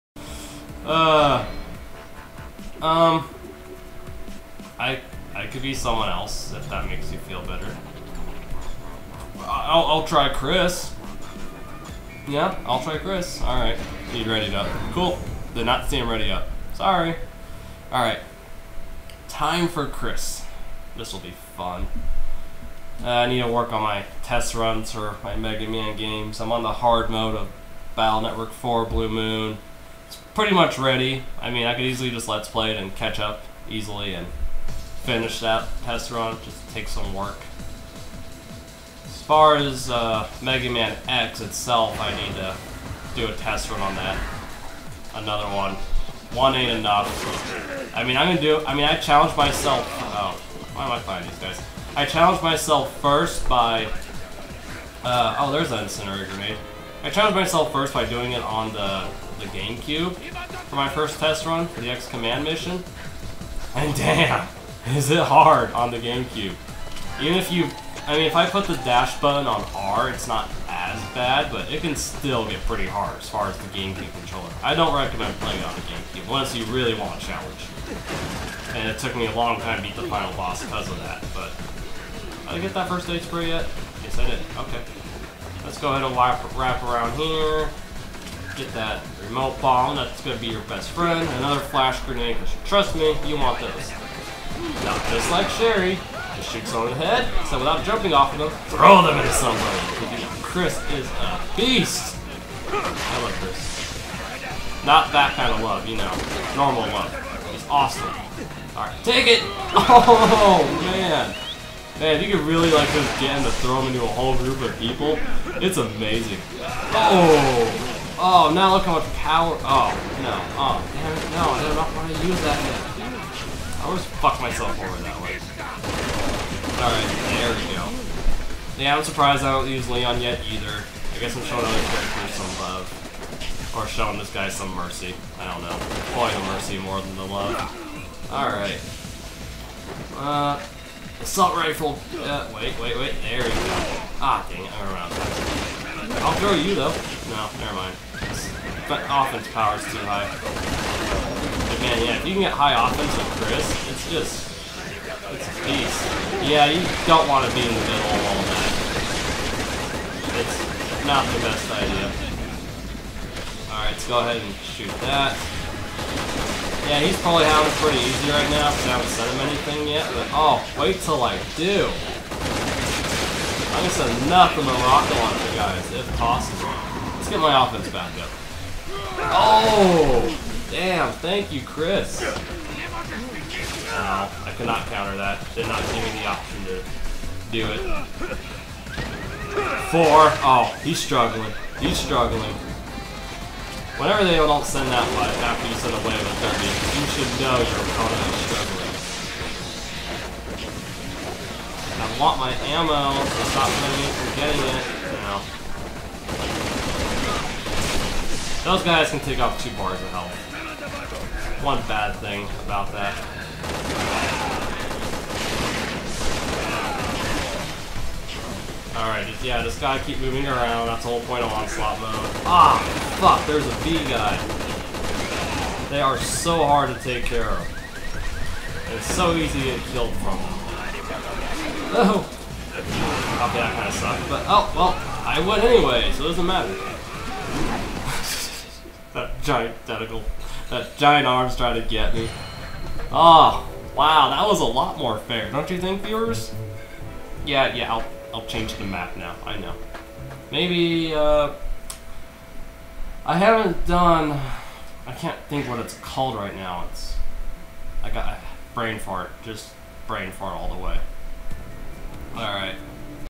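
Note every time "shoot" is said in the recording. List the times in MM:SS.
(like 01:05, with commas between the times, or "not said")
01:36, 02:44.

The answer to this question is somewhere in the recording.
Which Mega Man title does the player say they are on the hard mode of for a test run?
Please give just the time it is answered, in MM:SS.
00:27.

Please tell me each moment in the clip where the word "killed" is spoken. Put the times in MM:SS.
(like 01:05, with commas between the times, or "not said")
03:49.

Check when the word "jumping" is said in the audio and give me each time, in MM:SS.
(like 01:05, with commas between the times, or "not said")
01:37.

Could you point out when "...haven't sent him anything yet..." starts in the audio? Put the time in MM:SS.
02:48.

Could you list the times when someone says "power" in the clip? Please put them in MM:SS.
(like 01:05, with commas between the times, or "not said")
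01:59, 02:29.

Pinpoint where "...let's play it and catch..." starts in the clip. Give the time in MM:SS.
00:32.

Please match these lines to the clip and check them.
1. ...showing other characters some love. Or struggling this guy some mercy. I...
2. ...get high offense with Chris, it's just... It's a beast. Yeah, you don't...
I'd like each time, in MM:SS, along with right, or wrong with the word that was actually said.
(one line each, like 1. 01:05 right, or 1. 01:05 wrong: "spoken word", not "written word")
1. 02:11 wrong: "showing", not "struggling"
2. 02:32 right.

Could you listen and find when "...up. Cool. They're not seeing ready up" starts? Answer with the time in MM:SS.
00:14.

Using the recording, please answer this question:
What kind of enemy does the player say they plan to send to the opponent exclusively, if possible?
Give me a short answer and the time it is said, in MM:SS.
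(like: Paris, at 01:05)
rocket launcher guys, at 02:54.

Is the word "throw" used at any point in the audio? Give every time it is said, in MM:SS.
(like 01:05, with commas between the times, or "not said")
01:38, 01:53, 02:26.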